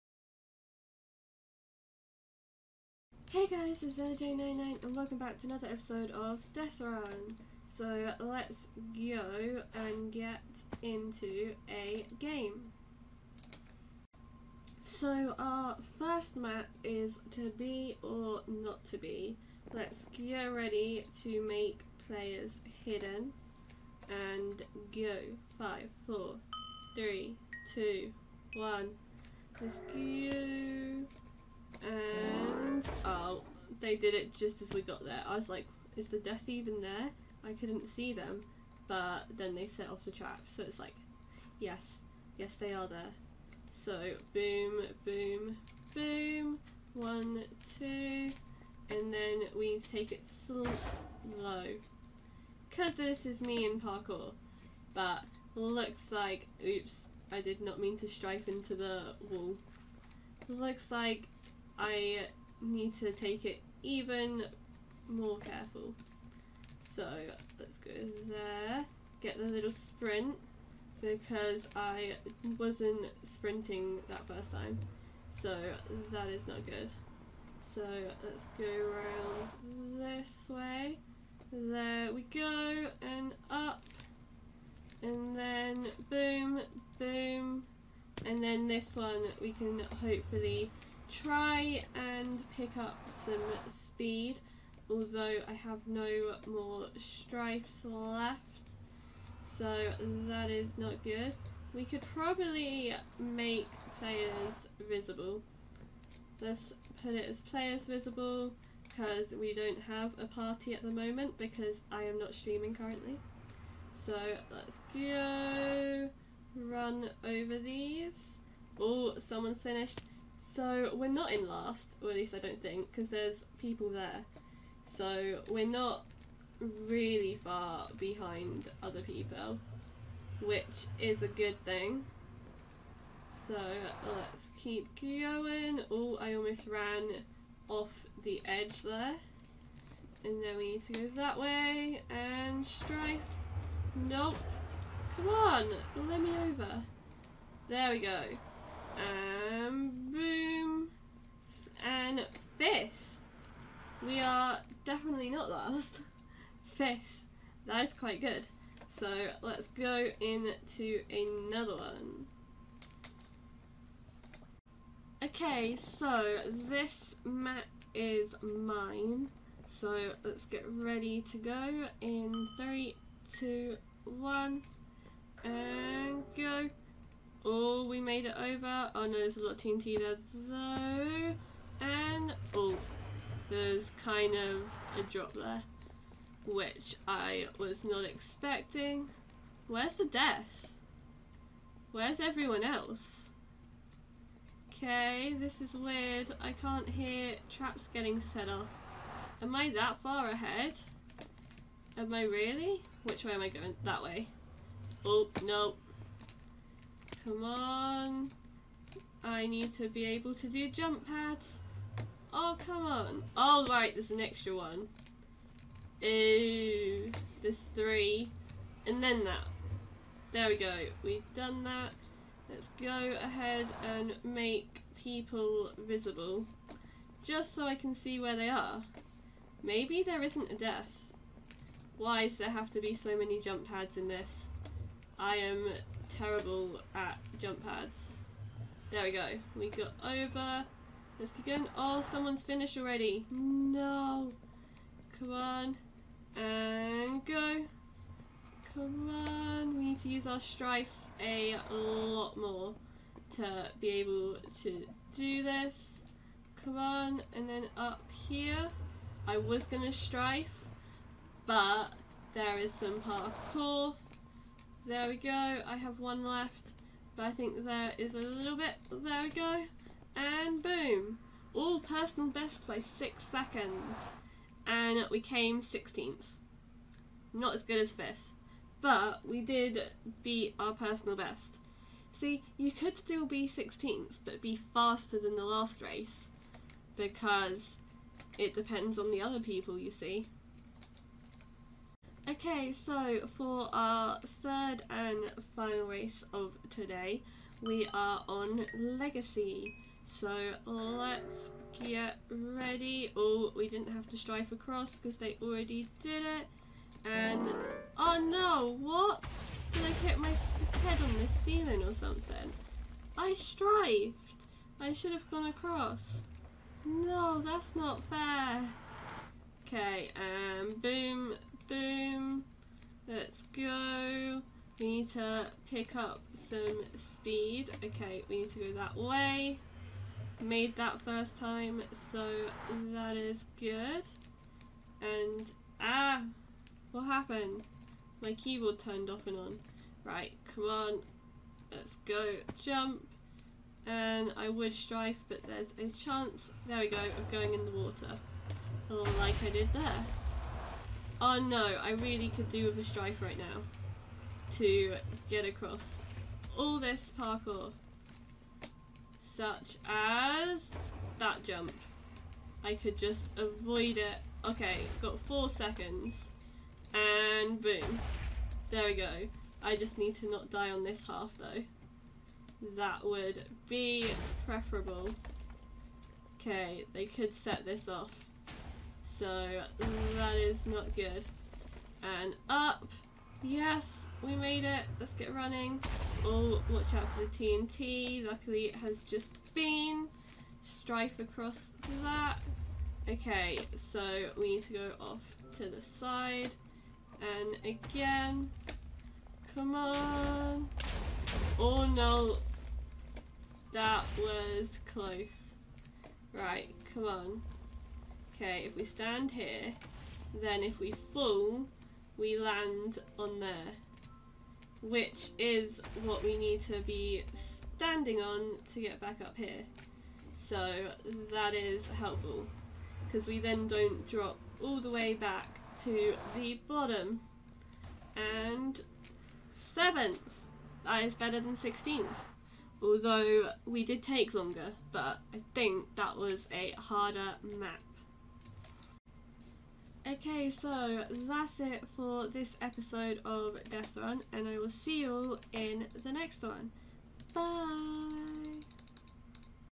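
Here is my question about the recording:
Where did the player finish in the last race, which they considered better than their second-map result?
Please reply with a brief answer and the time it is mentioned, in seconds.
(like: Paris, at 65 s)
7th, at 429 s.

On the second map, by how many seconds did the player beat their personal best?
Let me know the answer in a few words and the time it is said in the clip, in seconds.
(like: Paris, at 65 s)
6, at 272 s.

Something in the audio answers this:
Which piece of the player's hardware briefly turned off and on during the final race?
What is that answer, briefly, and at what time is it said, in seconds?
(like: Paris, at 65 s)
Keyboard, at 338 s.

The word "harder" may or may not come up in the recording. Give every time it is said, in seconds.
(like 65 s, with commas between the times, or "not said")
436 s.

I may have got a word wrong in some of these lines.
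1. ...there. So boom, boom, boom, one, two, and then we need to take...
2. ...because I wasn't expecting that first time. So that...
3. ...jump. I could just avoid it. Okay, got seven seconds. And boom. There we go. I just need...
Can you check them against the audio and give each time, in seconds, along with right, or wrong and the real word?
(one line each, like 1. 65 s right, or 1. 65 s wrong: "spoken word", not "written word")
1. 42 s right
2. 71 s wrong: "sprinting", not "expecting"
3. 361 s wrong: "four", not "seven".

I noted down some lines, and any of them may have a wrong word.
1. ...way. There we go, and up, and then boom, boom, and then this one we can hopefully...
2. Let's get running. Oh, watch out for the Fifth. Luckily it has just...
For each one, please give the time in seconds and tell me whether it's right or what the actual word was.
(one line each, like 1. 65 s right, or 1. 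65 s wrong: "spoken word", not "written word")
1. 80 s right
2. 384 s wrong: "TNT", not "Fifth".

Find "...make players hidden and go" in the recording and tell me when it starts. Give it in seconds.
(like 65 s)
21 s.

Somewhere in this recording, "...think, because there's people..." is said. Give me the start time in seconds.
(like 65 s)
122 s.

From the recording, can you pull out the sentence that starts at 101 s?
We could probably make players visible.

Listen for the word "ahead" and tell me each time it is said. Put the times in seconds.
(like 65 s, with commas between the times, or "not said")
200 s, 223 s.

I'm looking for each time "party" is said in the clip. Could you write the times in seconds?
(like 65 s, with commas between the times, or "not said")
110 s.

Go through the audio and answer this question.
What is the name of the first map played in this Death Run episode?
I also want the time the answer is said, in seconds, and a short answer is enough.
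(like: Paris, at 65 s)
To be or not to be, at 17 s.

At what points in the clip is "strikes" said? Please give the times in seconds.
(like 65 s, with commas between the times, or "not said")
96 s.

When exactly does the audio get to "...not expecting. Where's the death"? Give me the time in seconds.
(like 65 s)
187 s.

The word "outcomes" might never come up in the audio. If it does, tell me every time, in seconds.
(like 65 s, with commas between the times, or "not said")
not said.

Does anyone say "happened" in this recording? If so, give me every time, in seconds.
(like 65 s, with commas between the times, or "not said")
337 s.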